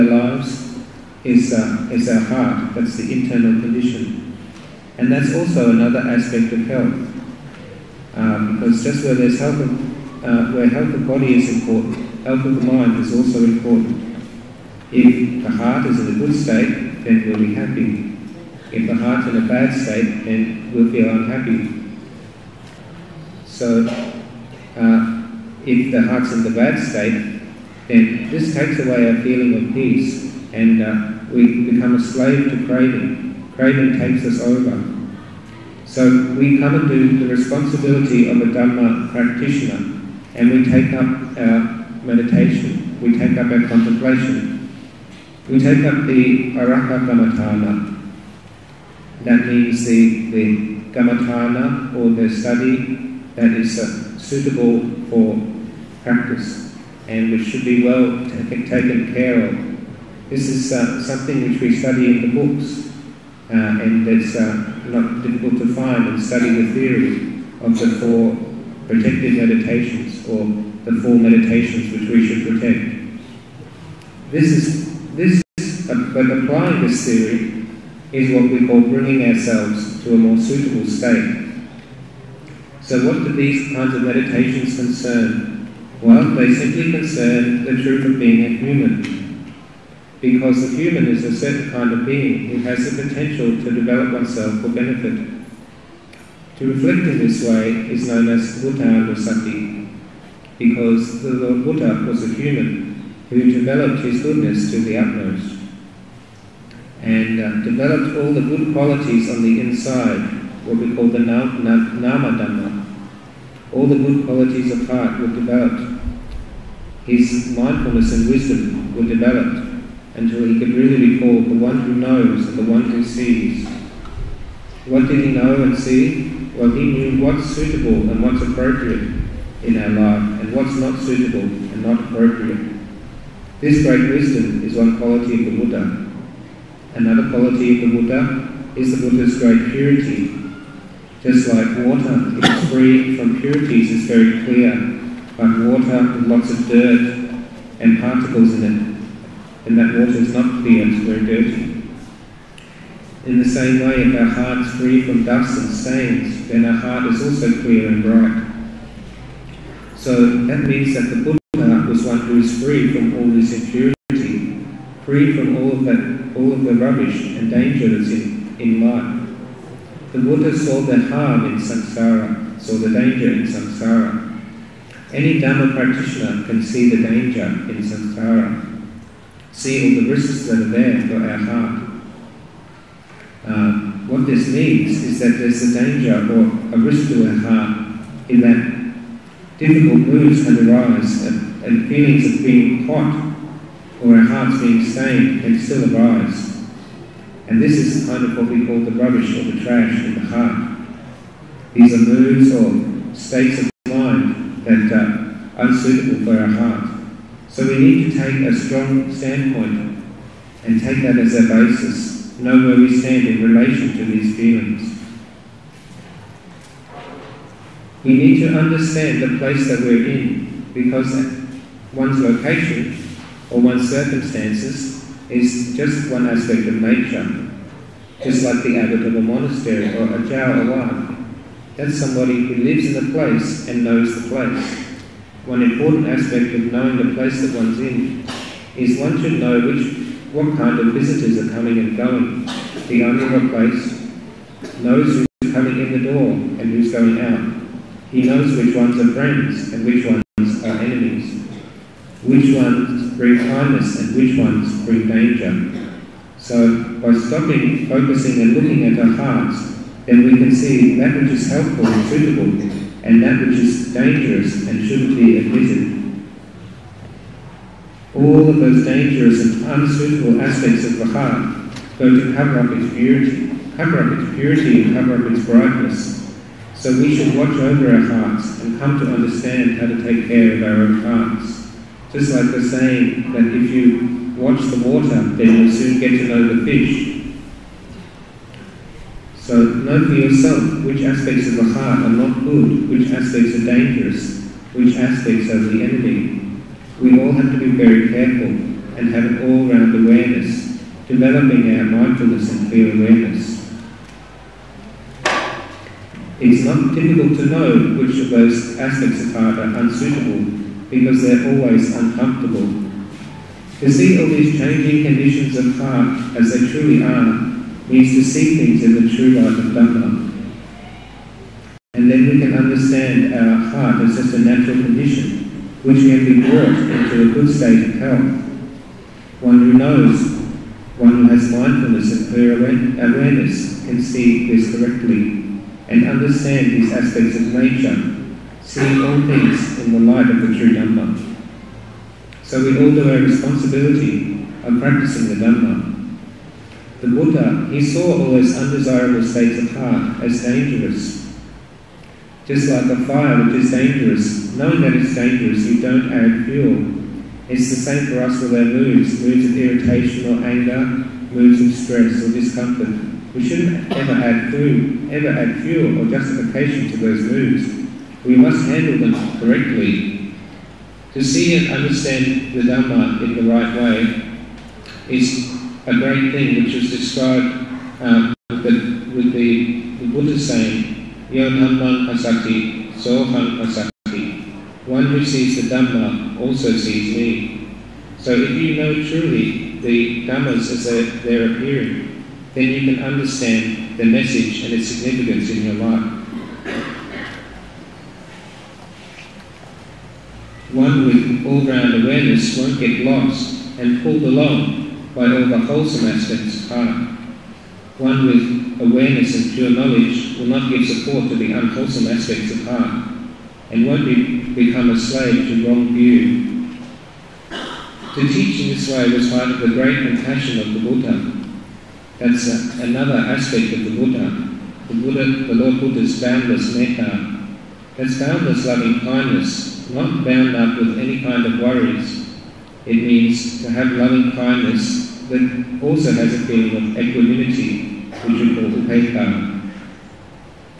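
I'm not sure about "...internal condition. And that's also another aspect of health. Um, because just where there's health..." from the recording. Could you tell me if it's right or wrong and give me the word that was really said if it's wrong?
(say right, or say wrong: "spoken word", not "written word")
right.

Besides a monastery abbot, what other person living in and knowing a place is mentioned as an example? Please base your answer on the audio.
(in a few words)
Jawa.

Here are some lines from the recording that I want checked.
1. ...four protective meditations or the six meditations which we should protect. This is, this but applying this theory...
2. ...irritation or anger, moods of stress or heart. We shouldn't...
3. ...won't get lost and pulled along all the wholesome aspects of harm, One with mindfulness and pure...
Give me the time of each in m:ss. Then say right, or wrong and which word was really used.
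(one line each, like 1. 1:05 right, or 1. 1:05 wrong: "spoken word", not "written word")
1. 1:07 wrong: "four", not "six"
2. 5:59 wrong: "discomfort", not "heart"
3. 6:42 wrong: "awareness", not "mindfulness".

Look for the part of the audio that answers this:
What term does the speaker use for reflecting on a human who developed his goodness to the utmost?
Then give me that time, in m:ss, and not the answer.
1:38.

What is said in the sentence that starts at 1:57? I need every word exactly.
His mindfulness and wisdom were developed until he could really recall the one who knows and the one who sees.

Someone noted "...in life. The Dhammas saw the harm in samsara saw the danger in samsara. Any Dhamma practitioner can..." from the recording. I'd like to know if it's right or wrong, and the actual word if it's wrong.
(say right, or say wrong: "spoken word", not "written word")
wrong: "Buddha", not "Dhammas".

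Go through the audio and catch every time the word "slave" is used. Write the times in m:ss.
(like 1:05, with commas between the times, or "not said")
0:32, 6:54.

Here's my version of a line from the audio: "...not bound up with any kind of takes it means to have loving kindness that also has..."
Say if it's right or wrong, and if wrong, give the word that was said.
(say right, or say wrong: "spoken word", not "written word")
wrong: "worries", not "takes".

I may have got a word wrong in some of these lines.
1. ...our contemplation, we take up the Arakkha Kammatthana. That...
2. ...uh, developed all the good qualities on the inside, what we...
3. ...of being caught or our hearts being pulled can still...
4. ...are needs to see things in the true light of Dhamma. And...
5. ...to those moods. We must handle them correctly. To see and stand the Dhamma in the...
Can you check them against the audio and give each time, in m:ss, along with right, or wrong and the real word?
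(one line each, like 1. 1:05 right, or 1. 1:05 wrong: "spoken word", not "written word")
1. 0:43 right
2. 1:47 right
3. 3:12 wrong: "stained", not "pulled"
4. 5:17 right
5. 6:06 wrong: "understand", not "stand".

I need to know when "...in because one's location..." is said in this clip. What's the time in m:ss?
3:40.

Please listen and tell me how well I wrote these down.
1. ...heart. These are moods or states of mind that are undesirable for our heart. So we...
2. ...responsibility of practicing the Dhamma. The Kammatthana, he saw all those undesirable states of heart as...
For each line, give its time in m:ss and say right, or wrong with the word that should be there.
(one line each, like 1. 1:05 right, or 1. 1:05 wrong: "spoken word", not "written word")
1. 3:20 wrong: "unsuitable", not "undesirable"
2. 5:43 wrong: "Buddha", not "Kammatthana".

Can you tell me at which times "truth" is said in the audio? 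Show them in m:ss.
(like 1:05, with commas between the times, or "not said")
1:27.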